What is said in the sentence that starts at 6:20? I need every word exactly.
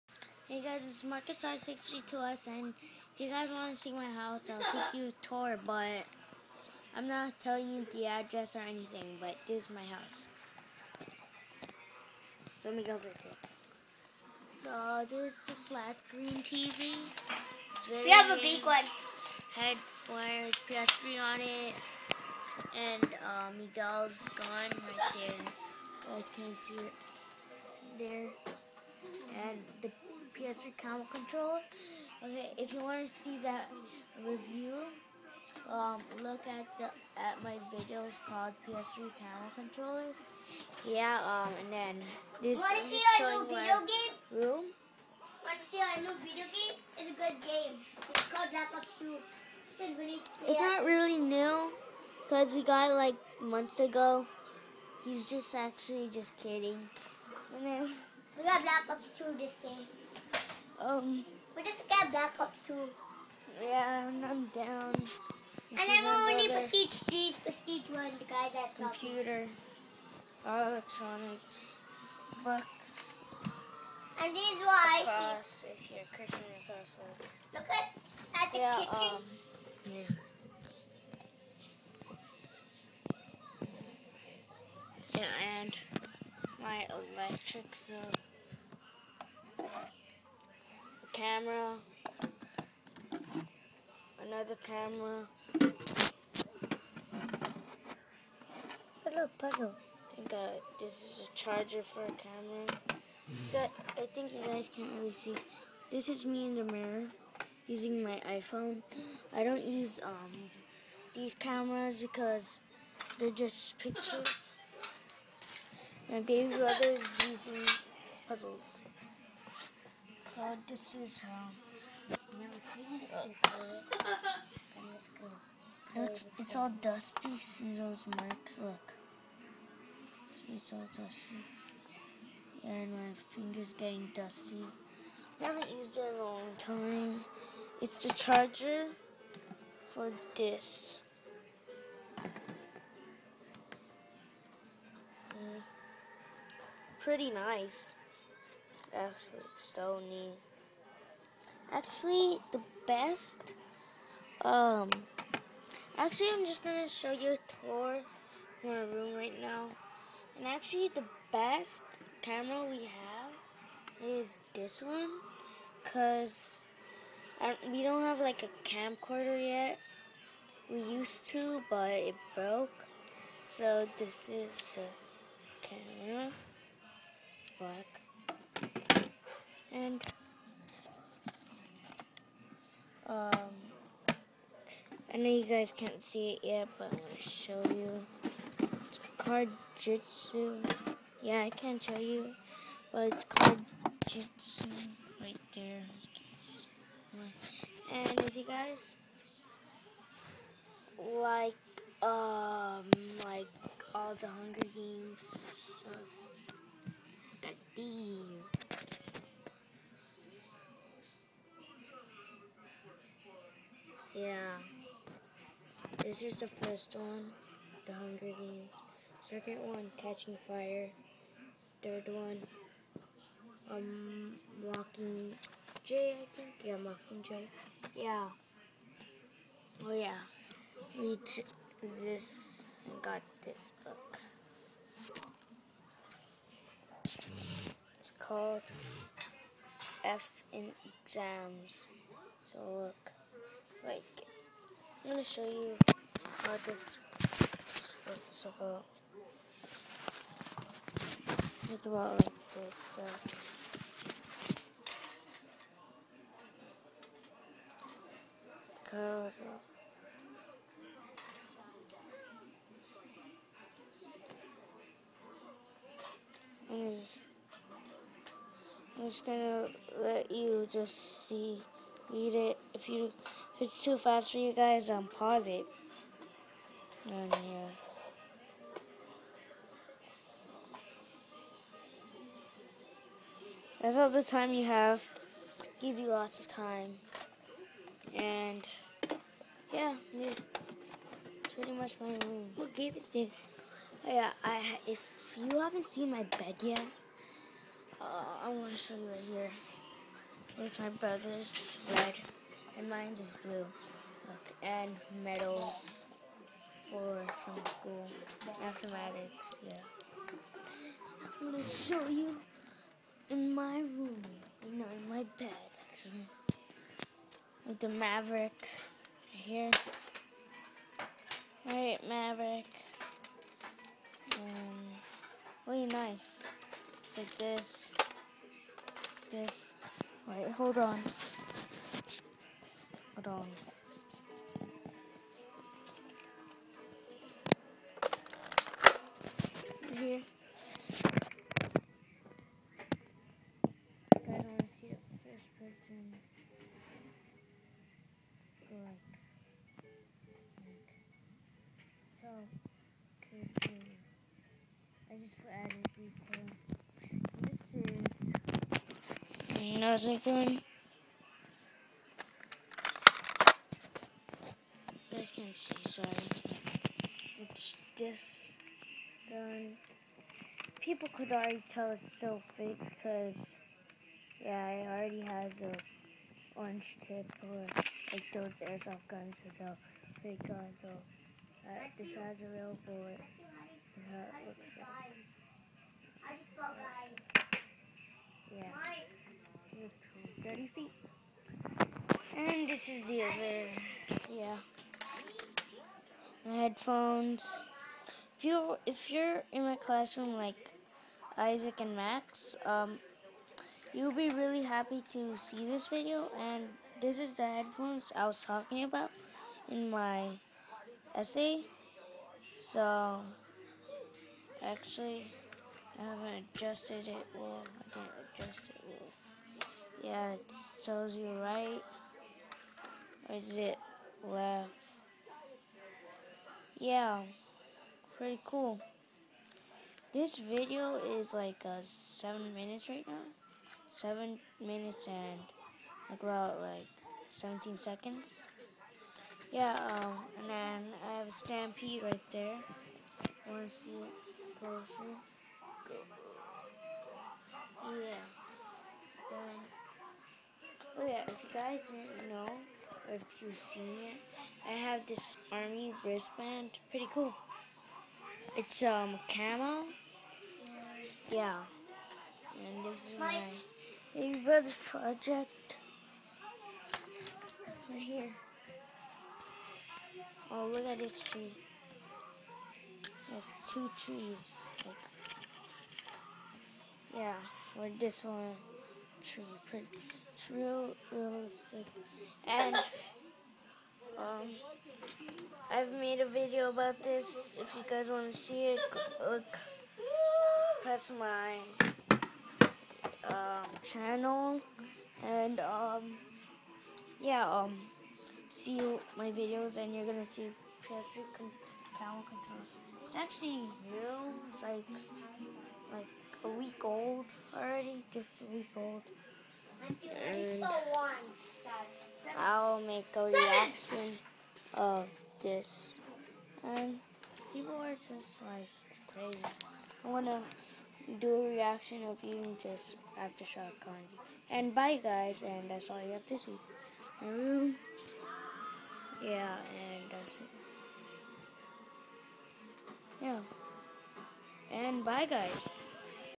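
Or, this decides a real bullet how it looks like.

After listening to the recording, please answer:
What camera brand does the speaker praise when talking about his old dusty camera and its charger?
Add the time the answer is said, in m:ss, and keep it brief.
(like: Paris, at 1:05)
Sony, at 2:29.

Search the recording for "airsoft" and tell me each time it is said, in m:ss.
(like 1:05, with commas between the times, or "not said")
6:18.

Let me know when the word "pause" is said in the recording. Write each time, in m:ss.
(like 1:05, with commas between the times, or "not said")
4:35.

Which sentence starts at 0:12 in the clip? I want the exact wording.
So let me go right here.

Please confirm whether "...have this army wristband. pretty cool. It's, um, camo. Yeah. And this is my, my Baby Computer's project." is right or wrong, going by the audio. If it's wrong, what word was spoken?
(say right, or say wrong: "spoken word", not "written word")
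wrong: "Brother", not "Computer".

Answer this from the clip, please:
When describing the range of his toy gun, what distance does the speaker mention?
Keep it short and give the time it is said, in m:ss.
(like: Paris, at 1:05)
30 feet, at 6:30.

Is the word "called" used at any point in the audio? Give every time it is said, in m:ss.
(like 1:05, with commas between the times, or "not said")
0:38, 0:48, 3:58.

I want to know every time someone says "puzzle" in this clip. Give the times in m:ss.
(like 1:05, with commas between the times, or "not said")
1:39, 1:58.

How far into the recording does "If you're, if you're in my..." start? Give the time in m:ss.
6:38.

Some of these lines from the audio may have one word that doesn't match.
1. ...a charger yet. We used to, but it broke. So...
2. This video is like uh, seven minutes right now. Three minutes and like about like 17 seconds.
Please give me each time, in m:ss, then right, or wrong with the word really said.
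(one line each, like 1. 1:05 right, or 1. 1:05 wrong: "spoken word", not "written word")
1. 2:48 wrong: "camcorder", not "charger"
2. 7:10 wrong: "Seven", not "Three".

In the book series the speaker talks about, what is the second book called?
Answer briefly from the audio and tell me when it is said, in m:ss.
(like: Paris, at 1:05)
Catching Fire, at 3:39.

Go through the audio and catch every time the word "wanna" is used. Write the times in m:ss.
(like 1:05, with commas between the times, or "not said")
7:23, 8:40.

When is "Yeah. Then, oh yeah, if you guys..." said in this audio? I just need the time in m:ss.
7:27.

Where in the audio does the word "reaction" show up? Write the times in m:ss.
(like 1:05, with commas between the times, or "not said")
8:33, 8:41.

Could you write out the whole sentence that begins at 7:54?
Like, yeah, for this one tree.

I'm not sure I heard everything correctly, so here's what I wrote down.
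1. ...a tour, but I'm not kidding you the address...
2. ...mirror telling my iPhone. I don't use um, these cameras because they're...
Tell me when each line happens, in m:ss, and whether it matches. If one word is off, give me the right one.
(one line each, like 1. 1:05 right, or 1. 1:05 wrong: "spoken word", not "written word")
1. 0:05 wrong: "telling", not "kidding"
2. 1:46 wrong: "using", not "telling".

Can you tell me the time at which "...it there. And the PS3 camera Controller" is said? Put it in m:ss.
0:26.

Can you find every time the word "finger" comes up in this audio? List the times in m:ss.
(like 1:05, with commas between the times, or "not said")
2:13.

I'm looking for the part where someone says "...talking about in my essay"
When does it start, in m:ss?
6:48.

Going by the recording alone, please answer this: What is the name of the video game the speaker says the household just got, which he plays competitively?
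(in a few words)
Black Ops 2.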